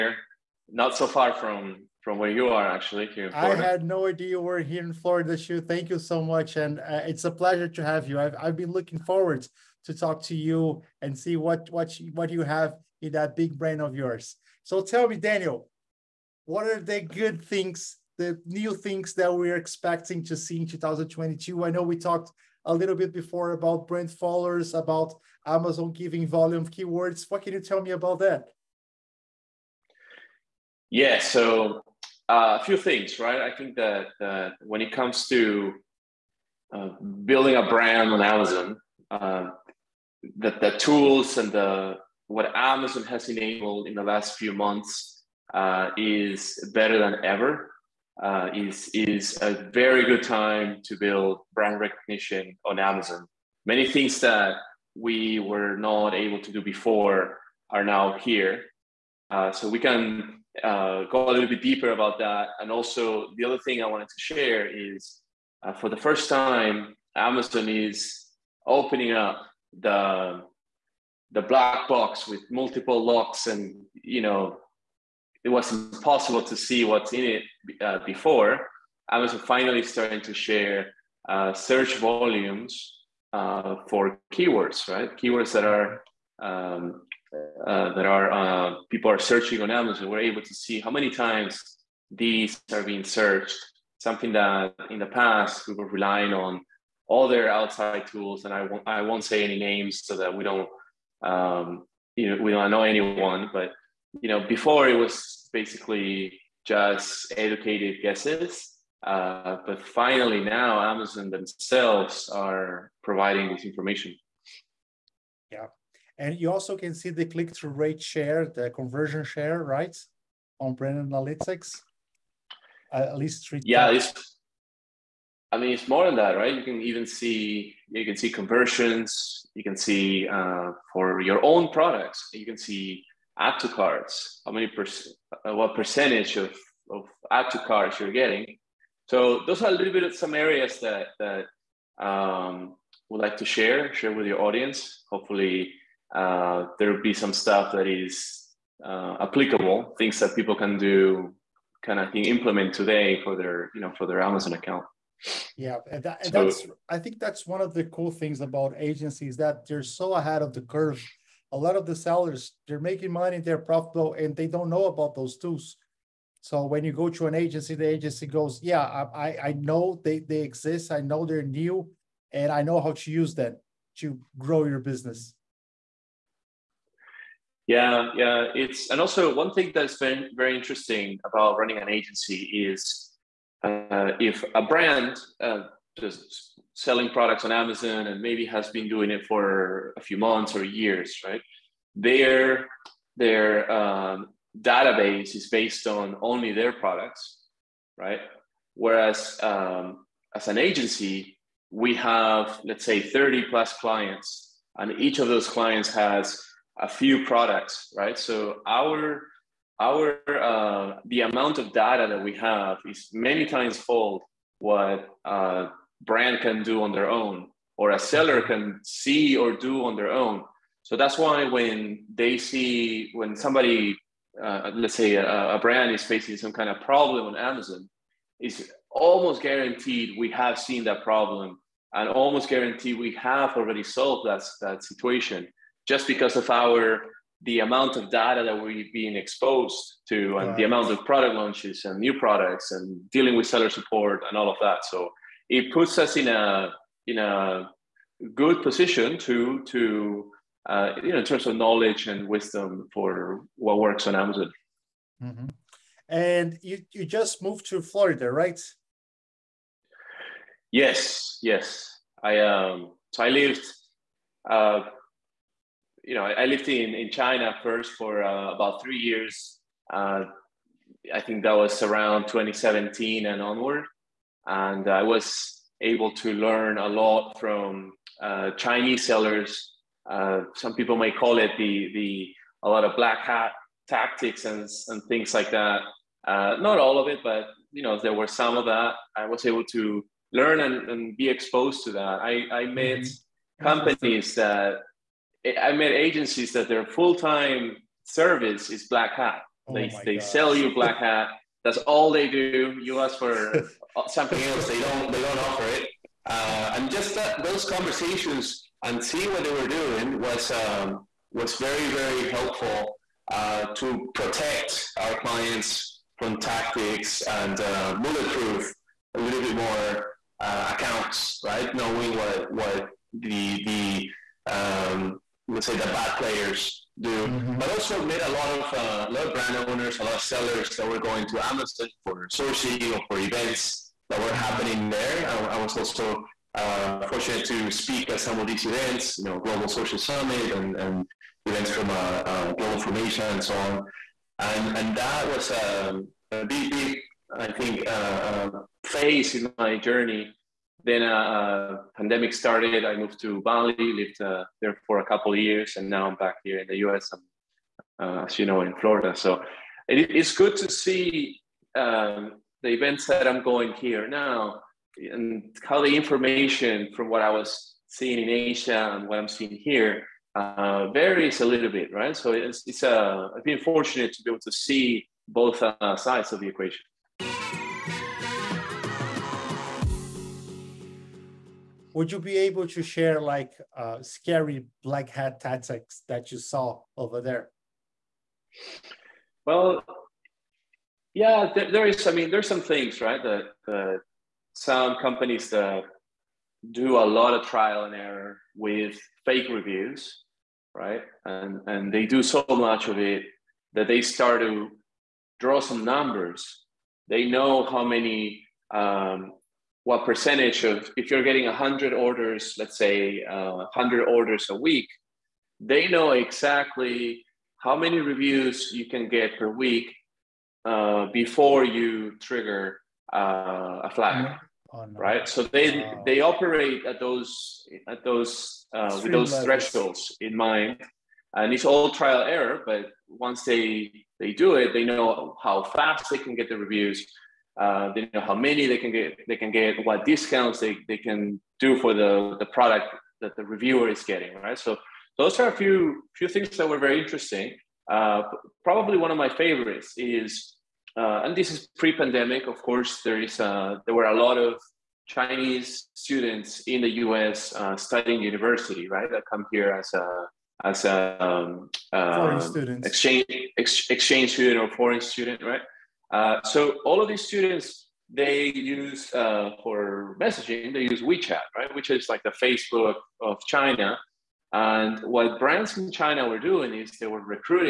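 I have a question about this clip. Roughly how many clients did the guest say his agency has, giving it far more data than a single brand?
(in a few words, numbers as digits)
30 plus.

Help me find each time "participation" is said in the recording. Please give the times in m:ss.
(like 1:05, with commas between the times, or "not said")
not said.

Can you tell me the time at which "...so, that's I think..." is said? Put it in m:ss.
2:36.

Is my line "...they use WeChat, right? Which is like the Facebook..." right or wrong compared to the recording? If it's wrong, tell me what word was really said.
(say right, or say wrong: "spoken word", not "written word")
right.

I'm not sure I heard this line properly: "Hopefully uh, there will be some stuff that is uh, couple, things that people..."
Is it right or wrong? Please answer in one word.
wrong.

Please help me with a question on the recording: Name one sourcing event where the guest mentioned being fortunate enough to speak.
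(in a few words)
Global Sourcing Summit.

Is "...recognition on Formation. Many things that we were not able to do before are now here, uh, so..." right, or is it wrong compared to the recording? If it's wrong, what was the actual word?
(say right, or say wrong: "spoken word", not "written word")
wrong: "Amazon", not "Formation".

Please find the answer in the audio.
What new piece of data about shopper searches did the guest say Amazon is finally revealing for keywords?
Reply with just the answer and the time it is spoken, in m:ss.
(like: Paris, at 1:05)
Search volumes, at 1:21.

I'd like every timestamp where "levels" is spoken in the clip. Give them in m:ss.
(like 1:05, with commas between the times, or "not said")
7:09.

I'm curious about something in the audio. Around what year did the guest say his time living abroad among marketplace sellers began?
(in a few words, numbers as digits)
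2017.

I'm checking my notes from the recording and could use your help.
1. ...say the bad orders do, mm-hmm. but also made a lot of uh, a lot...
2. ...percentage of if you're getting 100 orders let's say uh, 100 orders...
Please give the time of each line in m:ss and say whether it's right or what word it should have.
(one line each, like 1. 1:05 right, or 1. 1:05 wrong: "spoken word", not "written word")
1. 5:25 wrong: "players", not "orders"
2. 6:50 right.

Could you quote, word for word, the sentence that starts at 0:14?
So tell me, Daniel, what are the good things, the new things that we're expecting to see in 2022?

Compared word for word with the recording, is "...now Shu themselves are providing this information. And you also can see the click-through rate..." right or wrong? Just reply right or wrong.
wrong.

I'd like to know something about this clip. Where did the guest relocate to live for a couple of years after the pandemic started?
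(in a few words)
Bali.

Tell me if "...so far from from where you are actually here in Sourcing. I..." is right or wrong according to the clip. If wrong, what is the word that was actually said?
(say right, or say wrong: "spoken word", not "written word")
wrong: "Florida", not "Sourcing".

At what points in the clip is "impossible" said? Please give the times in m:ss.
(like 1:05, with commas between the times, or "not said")
1:15.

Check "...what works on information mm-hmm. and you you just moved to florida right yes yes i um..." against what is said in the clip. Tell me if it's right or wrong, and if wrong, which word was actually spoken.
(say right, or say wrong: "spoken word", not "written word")
wrong: "amazon", not "information".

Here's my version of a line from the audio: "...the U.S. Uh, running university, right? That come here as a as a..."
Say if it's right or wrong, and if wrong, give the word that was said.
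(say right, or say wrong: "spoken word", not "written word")
wrong: "studying", not "running".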